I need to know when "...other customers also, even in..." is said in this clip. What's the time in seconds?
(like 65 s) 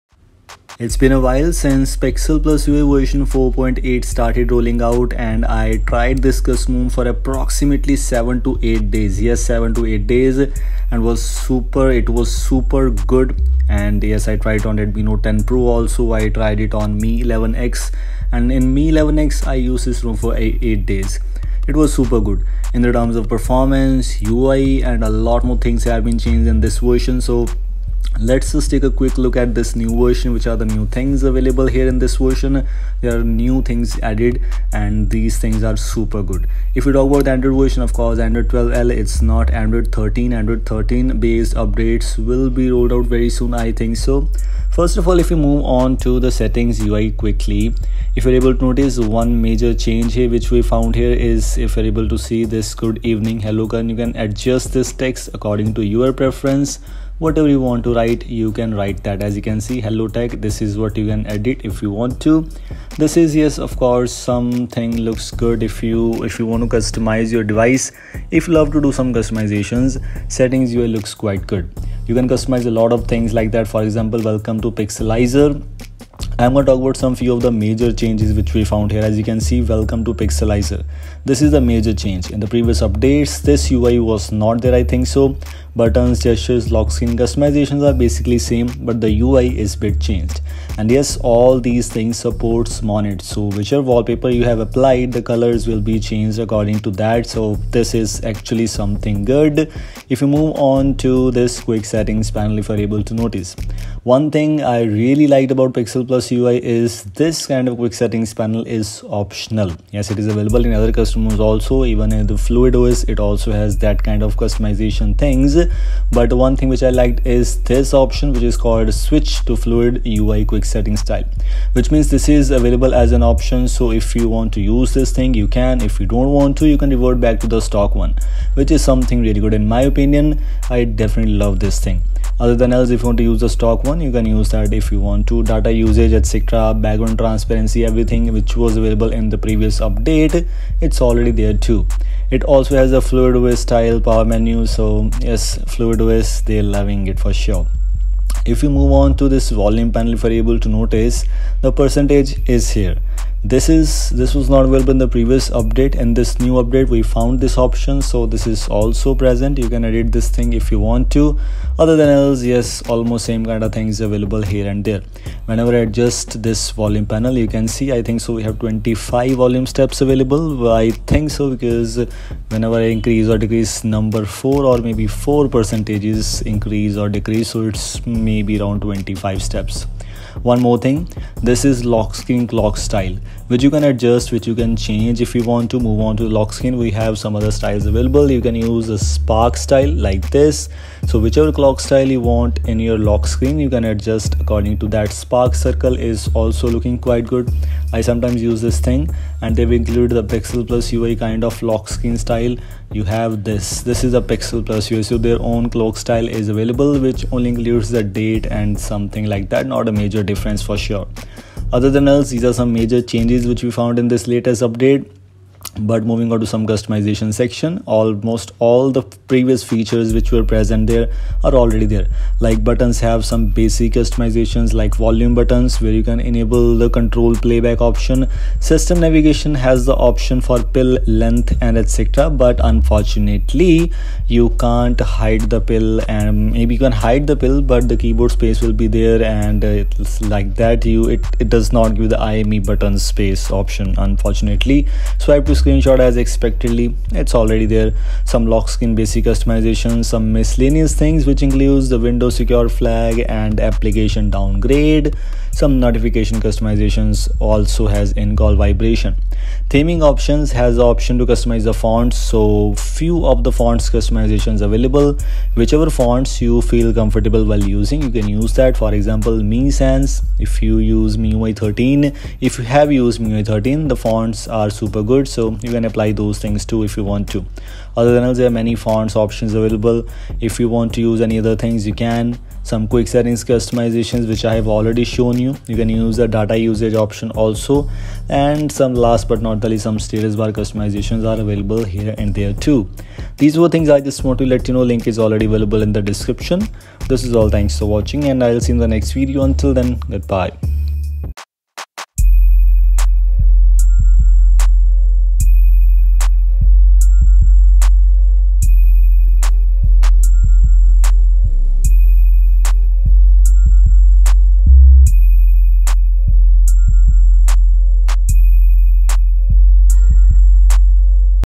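110 s.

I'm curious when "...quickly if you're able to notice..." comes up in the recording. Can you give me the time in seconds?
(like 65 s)
47 s.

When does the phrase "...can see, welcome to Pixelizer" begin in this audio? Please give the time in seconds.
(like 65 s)
79 s.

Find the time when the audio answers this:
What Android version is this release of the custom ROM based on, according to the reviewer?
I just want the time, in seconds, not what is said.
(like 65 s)
38 s.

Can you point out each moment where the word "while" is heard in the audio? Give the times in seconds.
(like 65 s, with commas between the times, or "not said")
1 s, 267 s.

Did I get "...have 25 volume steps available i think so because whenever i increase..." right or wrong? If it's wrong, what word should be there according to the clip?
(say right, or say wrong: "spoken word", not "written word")
right.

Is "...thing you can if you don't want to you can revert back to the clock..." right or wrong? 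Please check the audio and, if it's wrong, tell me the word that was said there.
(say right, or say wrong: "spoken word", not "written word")
wrong: "stock", not "clock".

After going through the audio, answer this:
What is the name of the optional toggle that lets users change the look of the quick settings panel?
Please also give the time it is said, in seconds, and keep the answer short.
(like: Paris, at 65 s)
Switch to Fluid UI quick setting style, at 118 s.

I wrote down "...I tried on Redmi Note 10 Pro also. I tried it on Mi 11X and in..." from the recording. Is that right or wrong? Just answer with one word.
right.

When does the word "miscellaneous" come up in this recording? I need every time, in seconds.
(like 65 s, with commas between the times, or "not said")
250 s.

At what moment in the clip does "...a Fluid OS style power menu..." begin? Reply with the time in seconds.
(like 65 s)
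142 s.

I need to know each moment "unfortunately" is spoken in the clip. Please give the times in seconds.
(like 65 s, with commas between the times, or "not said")
232 s, 243 s.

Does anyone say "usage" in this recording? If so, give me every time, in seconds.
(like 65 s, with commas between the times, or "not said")
135 s, 286 s.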